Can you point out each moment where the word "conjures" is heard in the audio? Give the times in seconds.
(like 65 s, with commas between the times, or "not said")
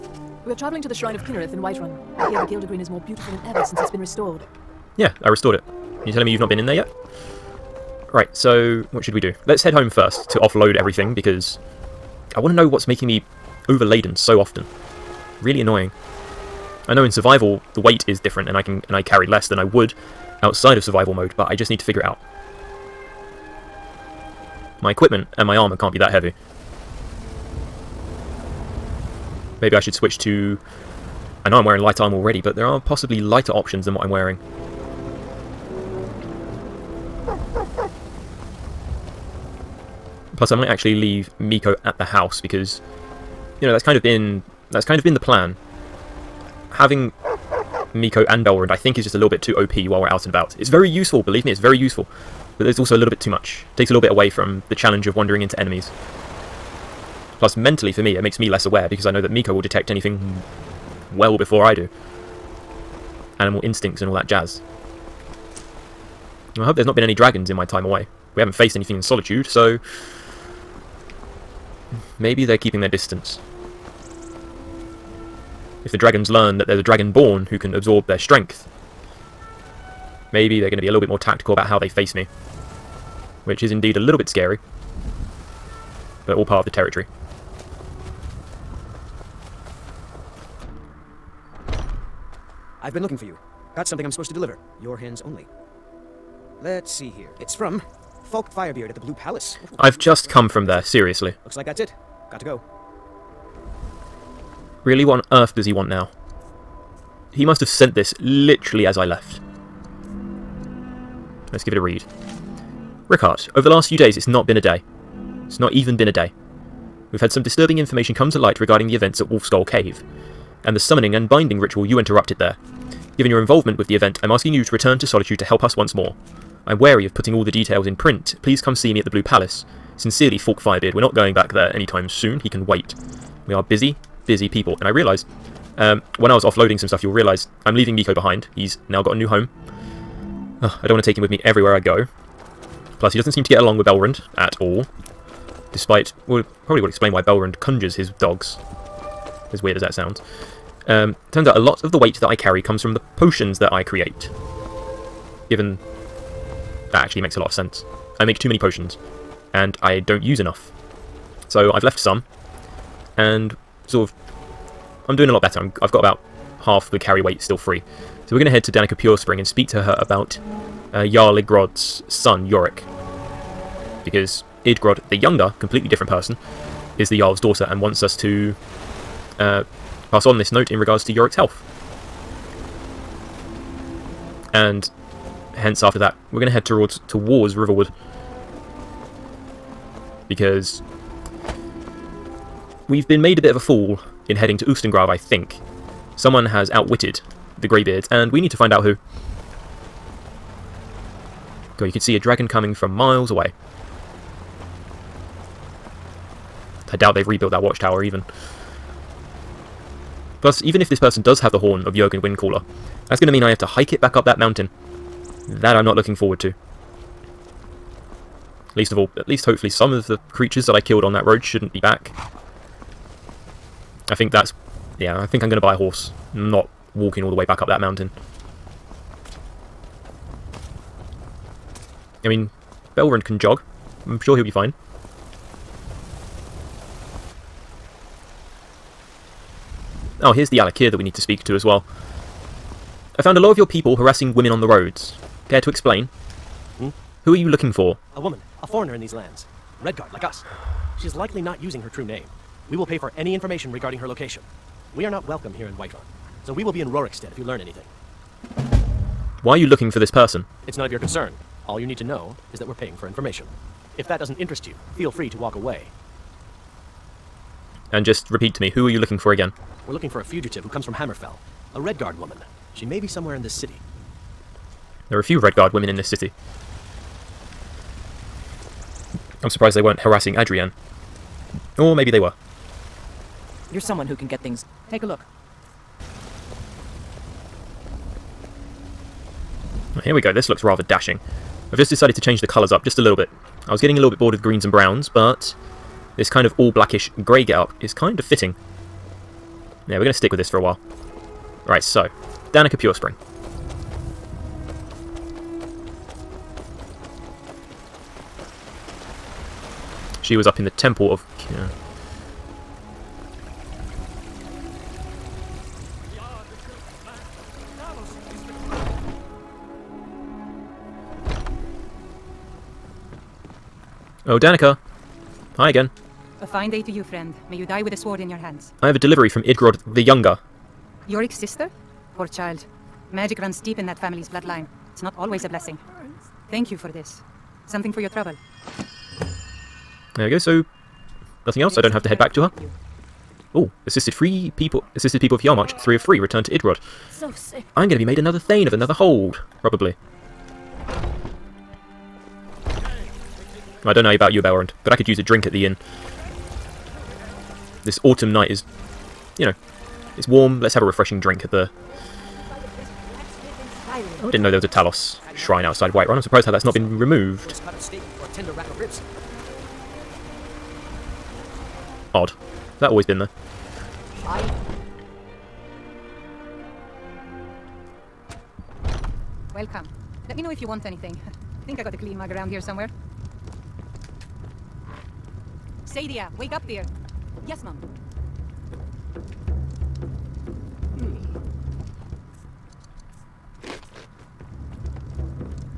147 s.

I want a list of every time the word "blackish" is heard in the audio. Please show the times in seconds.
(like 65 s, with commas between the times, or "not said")
296 s.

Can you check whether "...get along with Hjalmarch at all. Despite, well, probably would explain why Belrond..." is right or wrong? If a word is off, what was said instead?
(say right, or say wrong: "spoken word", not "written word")
wrong: "Belrond", not "Hjalmarch".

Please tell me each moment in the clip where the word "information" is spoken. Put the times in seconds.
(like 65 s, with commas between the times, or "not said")
117 s, 253 s, 263 s.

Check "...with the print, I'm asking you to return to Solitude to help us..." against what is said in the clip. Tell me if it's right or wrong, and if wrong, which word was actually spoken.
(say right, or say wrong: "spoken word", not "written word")
wrong: "event", not "print".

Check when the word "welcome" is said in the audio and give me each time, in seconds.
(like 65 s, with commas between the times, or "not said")
255 s, 379 s.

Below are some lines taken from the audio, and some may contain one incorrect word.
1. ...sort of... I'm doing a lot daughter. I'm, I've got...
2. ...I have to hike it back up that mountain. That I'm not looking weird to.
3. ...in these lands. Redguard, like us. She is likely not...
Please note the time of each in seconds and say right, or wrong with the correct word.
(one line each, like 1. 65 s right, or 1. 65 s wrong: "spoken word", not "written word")
1. 163 s wrong: "better", not "daughter"
2. 213 s wrong: "forward", not "weird"
3. 248 s right.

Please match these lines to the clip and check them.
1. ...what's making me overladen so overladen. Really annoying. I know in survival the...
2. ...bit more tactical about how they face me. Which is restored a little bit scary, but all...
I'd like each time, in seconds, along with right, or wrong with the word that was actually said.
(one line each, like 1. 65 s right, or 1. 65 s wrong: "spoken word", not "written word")
1. 12 s wrong: "often", not "overladen"
2. 80 s wrong: "indeed", not "restored".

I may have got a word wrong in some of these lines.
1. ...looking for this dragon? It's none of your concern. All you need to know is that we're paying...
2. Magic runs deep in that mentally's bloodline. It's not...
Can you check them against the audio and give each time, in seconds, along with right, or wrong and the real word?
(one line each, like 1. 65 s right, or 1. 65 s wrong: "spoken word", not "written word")
1. 259 s wrong: "person", not "dragon"
2. 333 s wrong: "family", not "mentally".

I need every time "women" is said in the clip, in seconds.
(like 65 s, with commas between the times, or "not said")
244 s, 275 s.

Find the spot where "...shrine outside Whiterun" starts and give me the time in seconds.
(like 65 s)
365 s.